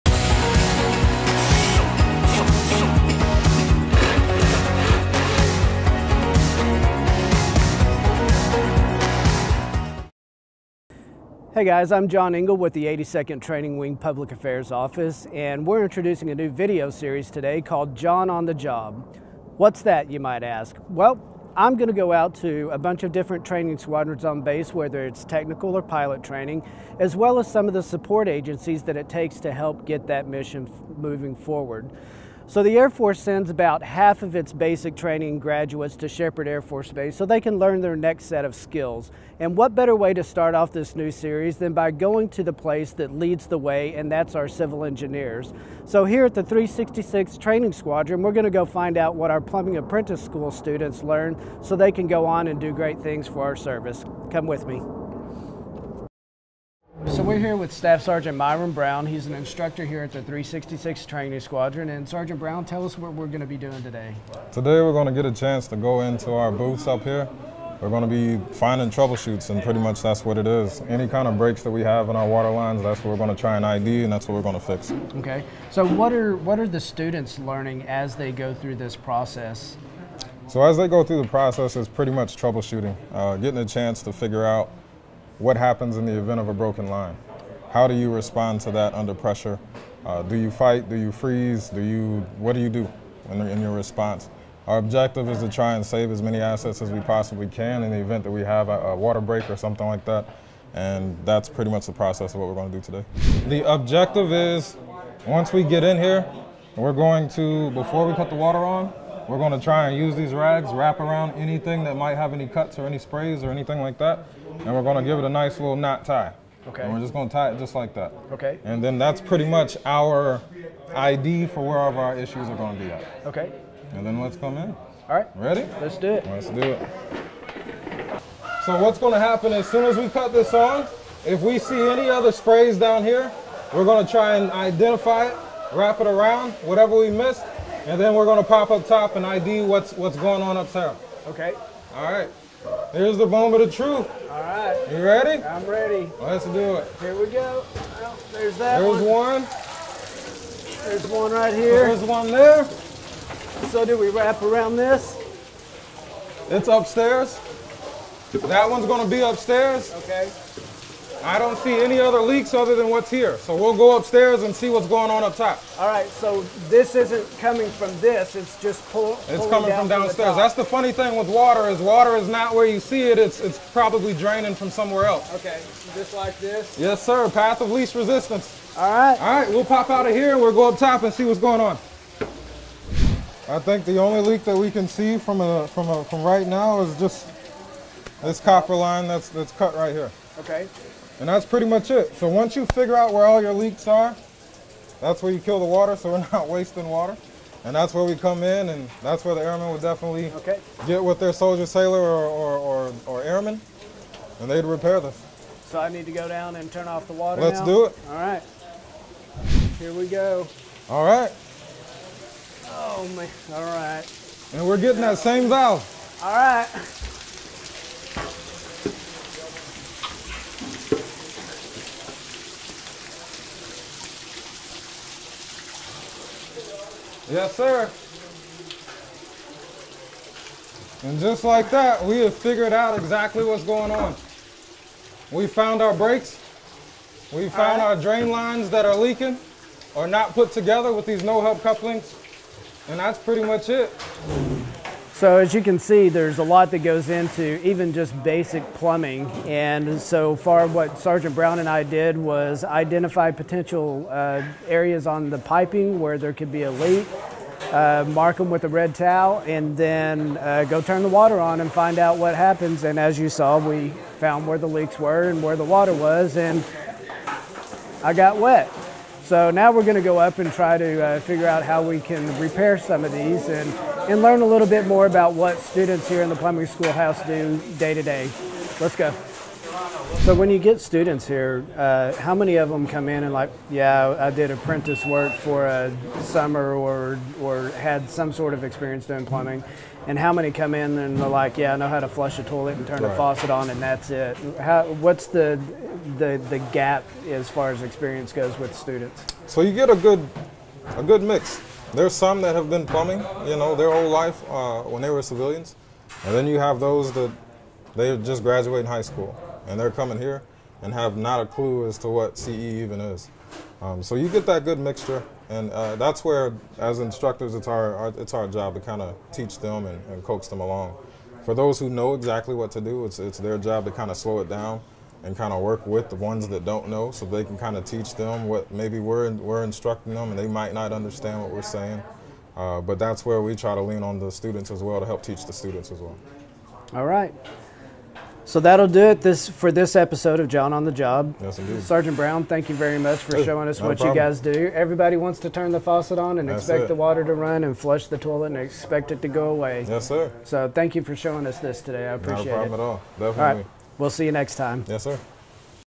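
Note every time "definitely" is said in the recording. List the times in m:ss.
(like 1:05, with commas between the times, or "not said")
3:19, 5:53.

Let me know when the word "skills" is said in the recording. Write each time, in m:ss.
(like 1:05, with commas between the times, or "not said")
0:38.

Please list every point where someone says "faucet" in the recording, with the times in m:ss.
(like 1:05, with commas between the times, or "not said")
4:53, 5:45.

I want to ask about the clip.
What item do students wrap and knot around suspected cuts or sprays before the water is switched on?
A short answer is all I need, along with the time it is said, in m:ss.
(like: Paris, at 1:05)
rags, at 1:50.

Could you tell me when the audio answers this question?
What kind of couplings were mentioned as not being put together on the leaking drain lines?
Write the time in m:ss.
4:01.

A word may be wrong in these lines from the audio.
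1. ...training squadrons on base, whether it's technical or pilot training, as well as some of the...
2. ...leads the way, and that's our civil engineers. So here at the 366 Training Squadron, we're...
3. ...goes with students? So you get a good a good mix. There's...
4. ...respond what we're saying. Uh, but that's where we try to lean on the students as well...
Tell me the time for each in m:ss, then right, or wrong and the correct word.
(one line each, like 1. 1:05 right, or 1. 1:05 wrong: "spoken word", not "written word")
1. 0:23 right
2. 0:43 right
3. 4:58 right
4. 5:30 wrong: "understand", not "respond".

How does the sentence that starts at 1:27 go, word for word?
How do you respond to that under pressure?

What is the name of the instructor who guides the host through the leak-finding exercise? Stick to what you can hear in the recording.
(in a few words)
Myron Brown.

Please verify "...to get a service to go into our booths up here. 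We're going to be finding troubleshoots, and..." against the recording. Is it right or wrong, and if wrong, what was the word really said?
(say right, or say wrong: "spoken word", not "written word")
wrong: "chance", not "service".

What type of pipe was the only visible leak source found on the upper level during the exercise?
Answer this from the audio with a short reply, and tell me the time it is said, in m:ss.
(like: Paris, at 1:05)
copper line, at 3:08.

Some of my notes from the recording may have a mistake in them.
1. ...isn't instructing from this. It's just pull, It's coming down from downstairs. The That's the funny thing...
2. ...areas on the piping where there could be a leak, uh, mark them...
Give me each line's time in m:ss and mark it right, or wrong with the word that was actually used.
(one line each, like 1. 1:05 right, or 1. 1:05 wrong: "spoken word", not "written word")
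1. 2:46 wrong: "coming", not "instructing"
2. 4:14 right.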